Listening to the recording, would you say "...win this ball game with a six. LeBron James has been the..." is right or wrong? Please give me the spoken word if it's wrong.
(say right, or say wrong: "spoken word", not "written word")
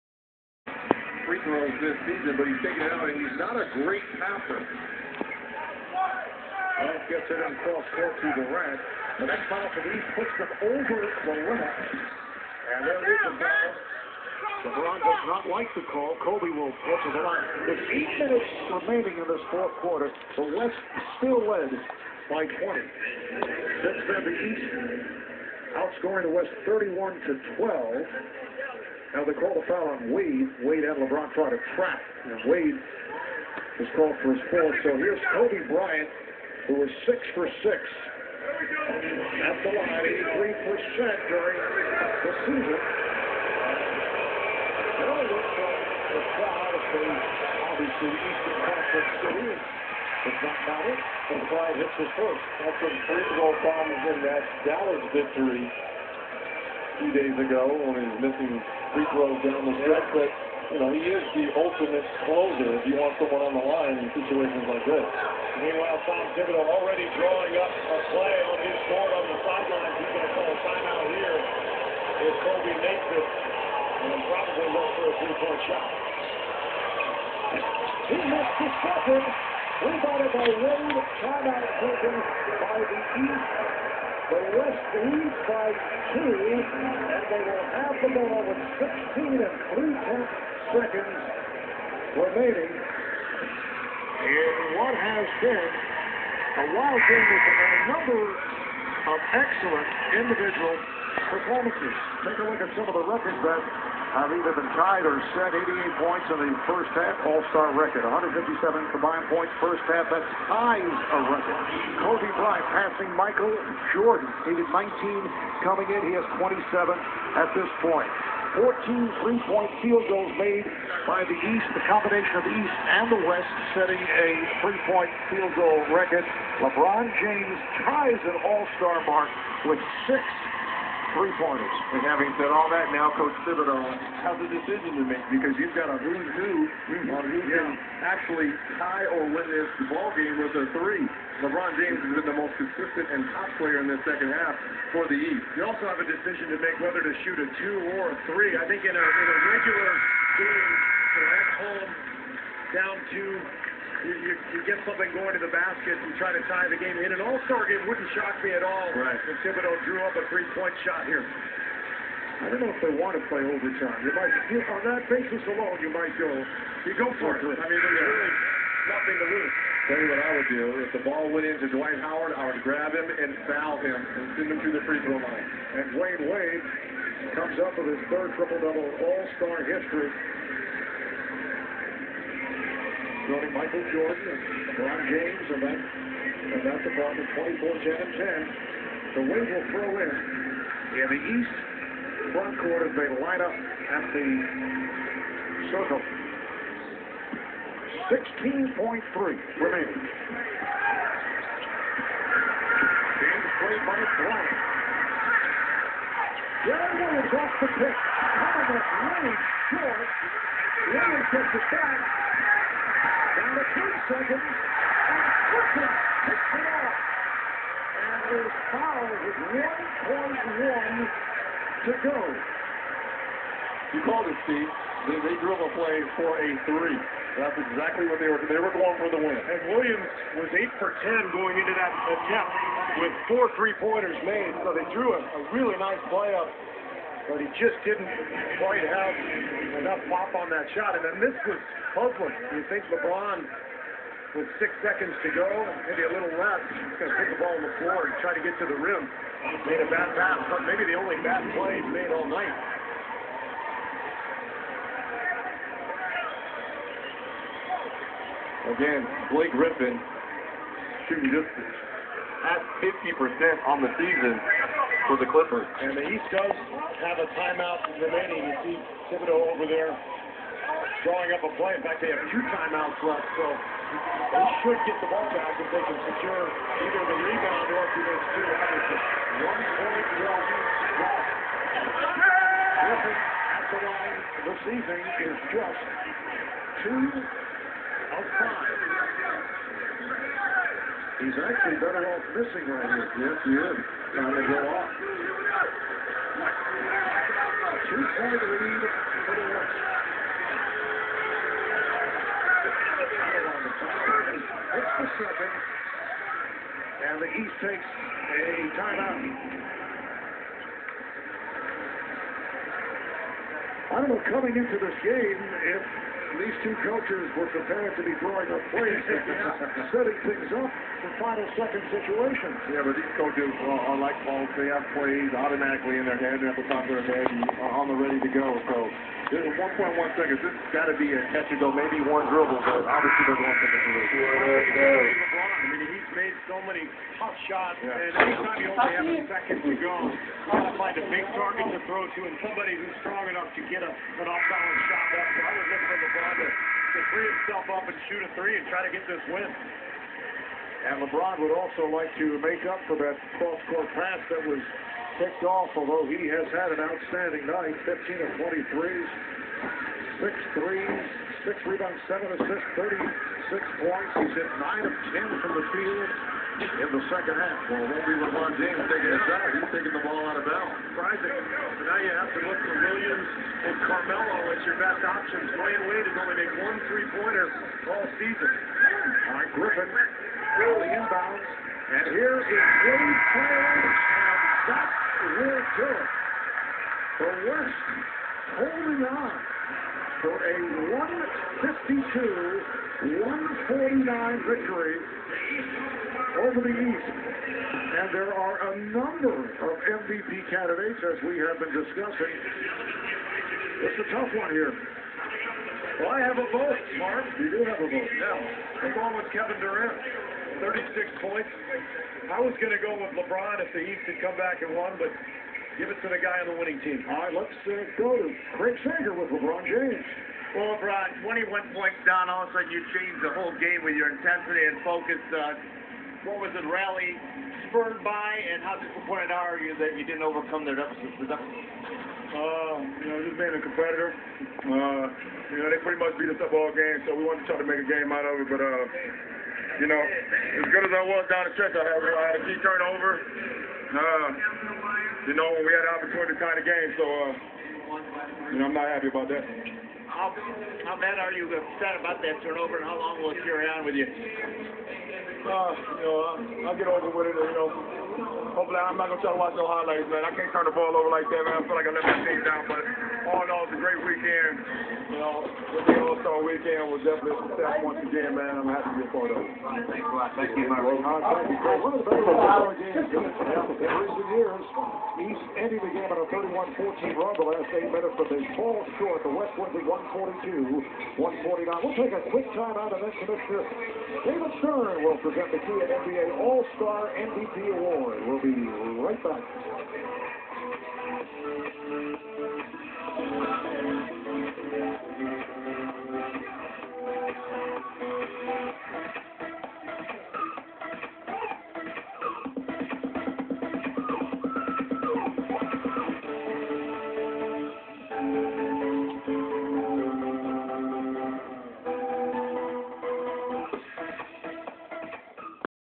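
wrong: "three", not "six".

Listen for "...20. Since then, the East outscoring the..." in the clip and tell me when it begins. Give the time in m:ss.
0:22.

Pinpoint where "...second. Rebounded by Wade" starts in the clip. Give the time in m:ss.
1:18.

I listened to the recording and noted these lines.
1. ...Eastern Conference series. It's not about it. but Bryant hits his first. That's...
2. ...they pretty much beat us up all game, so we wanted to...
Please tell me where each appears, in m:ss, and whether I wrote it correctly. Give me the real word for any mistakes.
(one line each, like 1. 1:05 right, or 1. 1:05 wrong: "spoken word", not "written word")
1. 0:48 right
2. 7:15 right.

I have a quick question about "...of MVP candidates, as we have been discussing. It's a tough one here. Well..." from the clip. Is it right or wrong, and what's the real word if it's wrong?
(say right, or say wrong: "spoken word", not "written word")
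right.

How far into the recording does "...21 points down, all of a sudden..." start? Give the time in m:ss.
7:01.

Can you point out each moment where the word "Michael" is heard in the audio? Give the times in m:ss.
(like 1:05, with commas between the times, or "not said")
1:53, 3:03.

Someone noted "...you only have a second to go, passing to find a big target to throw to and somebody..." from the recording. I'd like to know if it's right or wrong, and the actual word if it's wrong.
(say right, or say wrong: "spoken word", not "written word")
wrong: "trying", not "passing".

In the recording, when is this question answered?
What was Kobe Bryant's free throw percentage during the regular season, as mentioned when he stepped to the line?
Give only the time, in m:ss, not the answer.
0:40.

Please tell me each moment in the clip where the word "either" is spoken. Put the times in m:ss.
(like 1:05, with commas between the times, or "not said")
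1:44, 4:36.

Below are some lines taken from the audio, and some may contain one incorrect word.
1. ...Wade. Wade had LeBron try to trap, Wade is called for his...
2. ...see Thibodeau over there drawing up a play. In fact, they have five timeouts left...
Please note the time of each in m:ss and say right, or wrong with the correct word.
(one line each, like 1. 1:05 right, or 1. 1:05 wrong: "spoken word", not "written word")
1. 0:30 right
2. 4:28 wrong: "two", not "five".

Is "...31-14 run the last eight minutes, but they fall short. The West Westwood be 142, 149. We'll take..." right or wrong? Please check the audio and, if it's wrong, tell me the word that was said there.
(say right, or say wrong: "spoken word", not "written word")
right.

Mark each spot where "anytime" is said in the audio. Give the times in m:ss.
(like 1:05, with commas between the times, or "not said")
5:38.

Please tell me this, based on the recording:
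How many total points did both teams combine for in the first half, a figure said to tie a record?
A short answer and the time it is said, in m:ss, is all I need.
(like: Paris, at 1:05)
157, at 1:48.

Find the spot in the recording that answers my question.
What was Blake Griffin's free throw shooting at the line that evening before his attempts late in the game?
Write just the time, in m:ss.
4:46.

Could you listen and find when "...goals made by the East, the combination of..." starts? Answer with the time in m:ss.
2:00.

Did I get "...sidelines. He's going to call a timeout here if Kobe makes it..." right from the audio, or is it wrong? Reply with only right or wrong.
right.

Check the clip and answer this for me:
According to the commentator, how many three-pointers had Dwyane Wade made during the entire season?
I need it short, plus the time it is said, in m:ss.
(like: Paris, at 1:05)
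1, at 6:16.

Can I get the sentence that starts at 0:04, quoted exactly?
Well, gets it on cross court to Durant.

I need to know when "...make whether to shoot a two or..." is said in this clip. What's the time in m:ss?
2:26.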